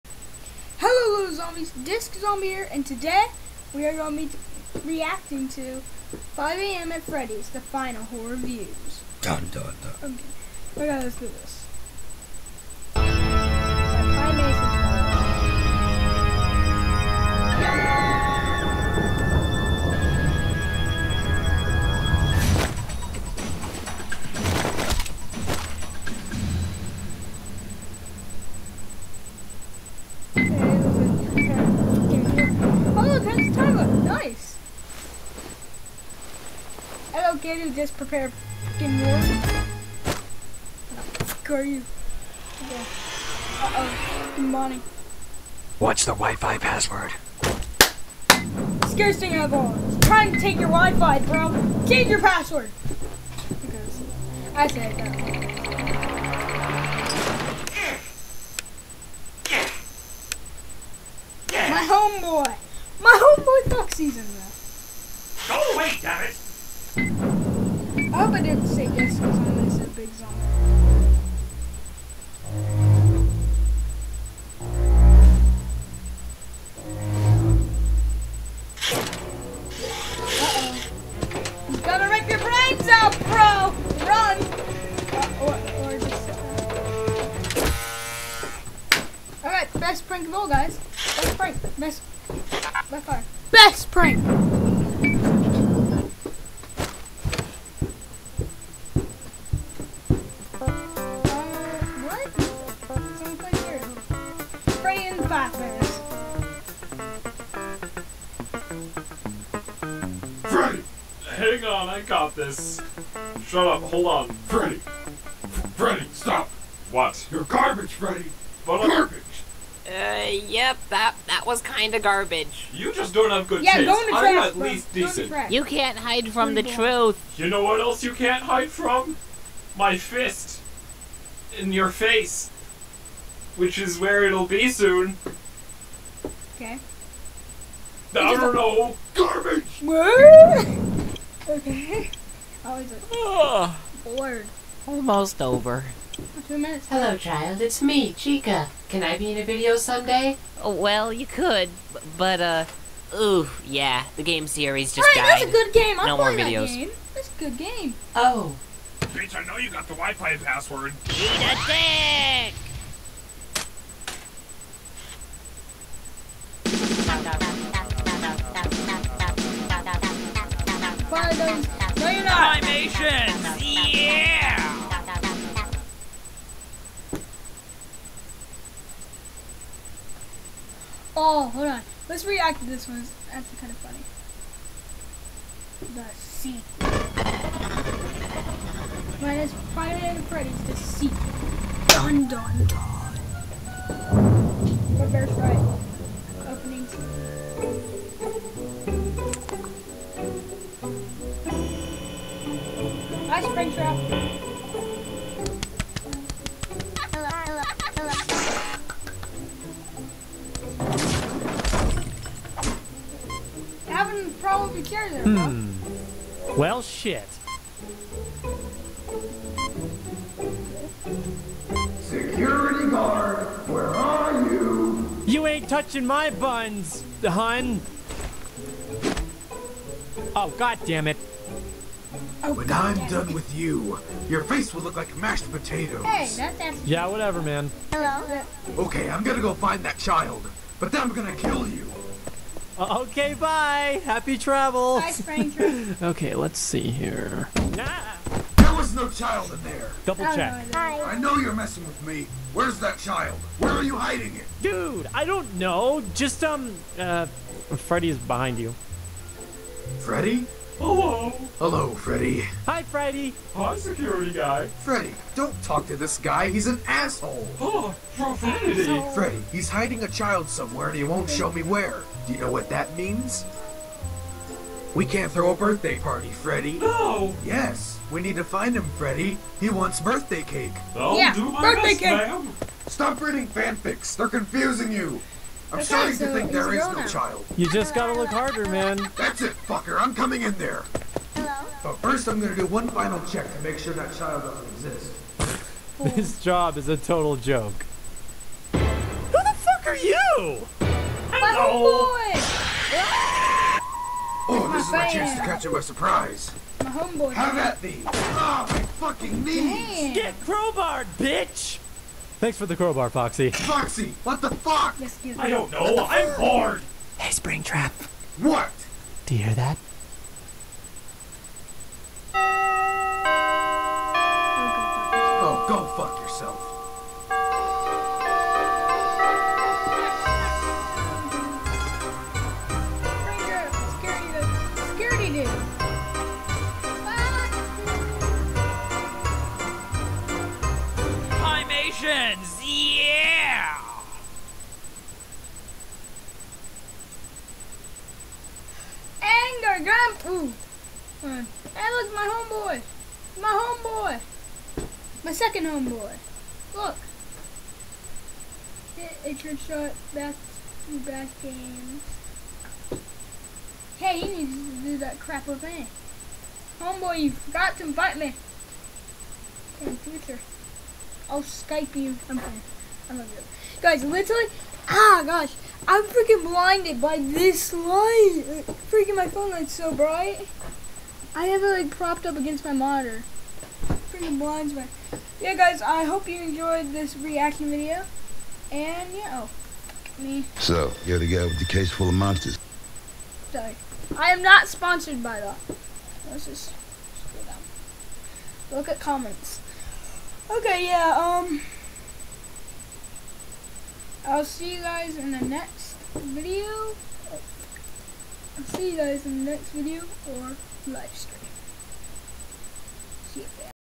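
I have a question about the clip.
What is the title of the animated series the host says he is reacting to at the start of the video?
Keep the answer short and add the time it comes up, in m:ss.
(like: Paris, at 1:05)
5 a.m. at Freddy's, at 0:06.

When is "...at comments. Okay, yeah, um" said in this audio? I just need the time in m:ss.
6:38.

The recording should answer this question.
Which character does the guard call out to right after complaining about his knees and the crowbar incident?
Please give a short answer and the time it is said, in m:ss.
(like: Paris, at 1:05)
Springtrap, at 5:17.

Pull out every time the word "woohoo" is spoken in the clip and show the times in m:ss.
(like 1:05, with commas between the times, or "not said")
not said.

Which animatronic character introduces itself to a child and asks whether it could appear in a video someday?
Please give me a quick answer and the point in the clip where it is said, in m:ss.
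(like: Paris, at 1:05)
Chica, at 2:28.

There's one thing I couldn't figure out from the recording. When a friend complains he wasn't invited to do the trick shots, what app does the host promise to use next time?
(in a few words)
Skype.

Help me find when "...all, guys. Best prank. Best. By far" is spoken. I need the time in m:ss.
1:30.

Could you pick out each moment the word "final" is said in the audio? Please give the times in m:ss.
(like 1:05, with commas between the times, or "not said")
0:07, 4:52.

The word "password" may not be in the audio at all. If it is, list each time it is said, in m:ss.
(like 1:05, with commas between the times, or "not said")
0:46, 0:52, 2:40.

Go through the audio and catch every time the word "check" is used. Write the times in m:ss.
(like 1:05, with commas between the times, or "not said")
4:10, 4:53.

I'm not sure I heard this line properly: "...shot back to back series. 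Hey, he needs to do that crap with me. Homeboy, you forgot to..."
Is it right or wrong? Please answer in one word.
wrong.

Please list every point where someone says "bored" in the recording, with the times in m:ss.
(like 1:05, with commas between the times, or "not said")
2:24, 5:16.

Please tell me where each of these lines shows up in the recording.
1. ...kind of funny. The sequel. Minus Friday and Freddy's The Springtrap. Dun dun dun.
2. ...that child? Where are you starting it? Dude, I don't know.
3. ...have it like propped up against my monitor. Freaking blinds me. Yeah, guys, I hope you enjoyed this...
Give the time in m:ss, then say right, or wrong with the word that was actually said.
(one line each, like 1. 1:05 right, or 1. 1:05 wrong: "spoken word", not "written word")
1. 3:03 wrong: "Sequel", not "Springtrap"
2. 4:12 wrong: "hiding", not "starting"
3. 6:21 right.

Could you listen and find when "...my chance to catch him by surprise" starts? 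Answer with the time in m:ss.
5:04.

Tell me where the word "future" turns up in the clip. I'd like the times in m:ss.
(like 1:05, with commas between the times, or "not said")
6:09.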